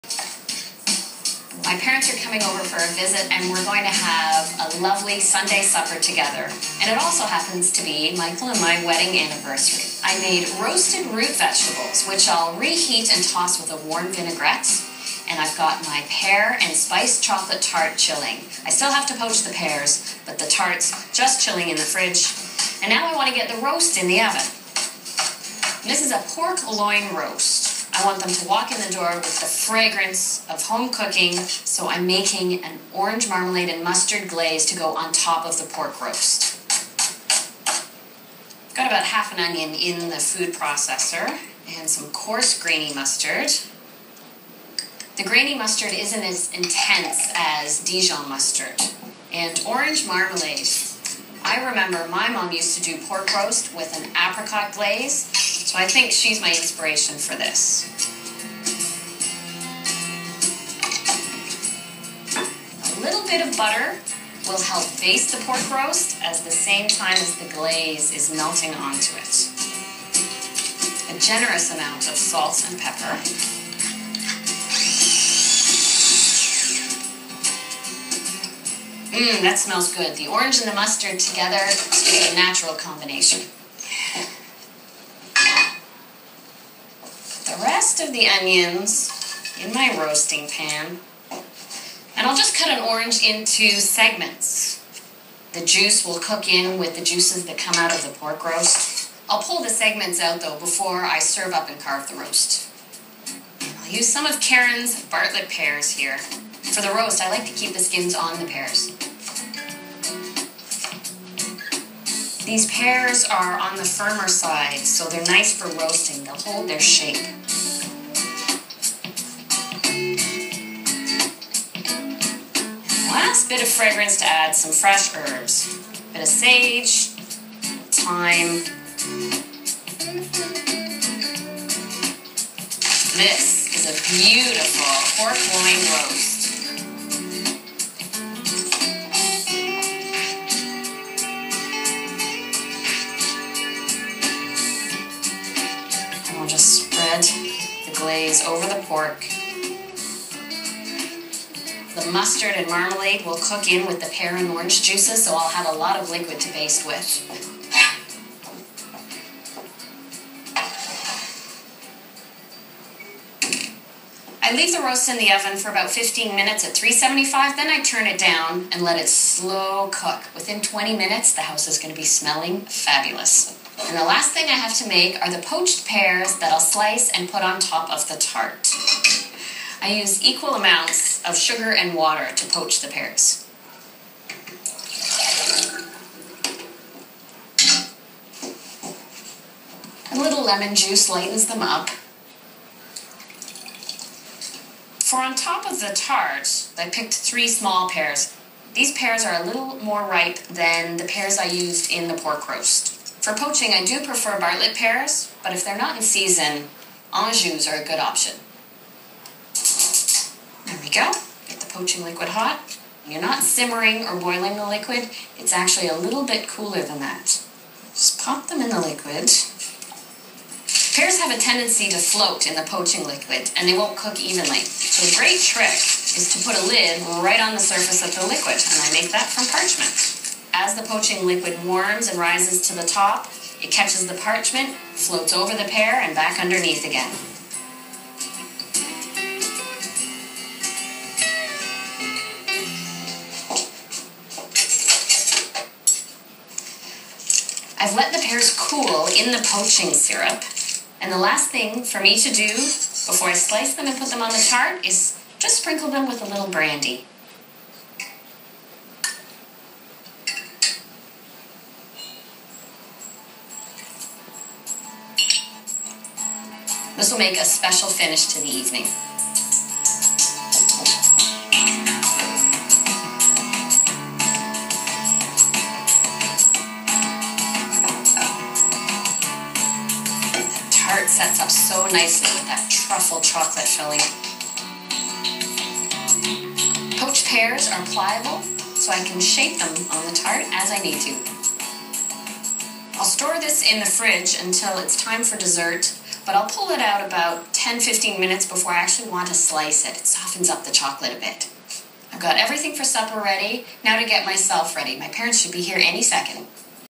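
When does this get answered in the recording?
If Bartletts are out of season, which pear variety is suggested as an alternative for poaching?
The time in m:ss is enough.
3:27.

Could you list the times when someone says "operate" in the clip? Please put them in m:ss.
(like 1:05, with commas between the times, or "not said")
not said.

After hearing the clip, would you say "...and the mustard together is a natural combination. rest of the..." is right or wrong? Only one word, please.
right.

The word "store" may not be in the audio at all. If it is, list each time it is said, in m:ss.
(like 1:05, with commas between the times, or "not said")
4:53.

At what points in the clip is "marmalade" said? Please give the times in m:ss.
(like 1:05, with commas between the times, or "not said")
0:33, 0:50, 2:32.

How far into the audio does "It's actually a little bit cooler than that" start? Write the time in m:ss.
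3:35.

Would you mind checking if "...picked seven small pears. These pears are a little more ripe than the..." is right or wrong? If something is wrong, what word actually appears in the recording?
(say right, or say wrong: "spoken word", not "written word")
wrong: "three", not "seven".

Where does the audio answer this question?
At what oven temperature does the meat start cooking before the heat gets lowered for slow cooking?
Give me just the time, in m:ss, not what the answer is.
2:46.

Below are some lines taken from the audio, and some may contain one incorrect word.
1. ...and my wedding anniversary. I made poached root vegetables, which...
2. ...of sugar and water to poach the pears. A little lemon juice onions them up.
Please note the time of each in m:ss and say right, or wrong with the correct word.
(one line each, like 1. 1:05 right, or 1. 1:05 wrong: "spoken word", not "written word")
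1. 0:08 wrong: "roasted", not "poached"
2. 3:01 wrong: "lightens", not "onions".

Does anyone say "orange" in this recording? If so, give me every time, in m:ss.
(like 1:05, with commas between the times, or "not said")
0:32, 0:49, 1:20, 1:32, 2:34.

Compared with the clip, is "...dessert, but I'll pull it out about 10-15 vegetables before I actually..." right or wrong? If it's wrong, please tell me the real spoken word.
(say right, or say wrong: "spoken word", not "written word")
wrong: "minutes", not "vegetables".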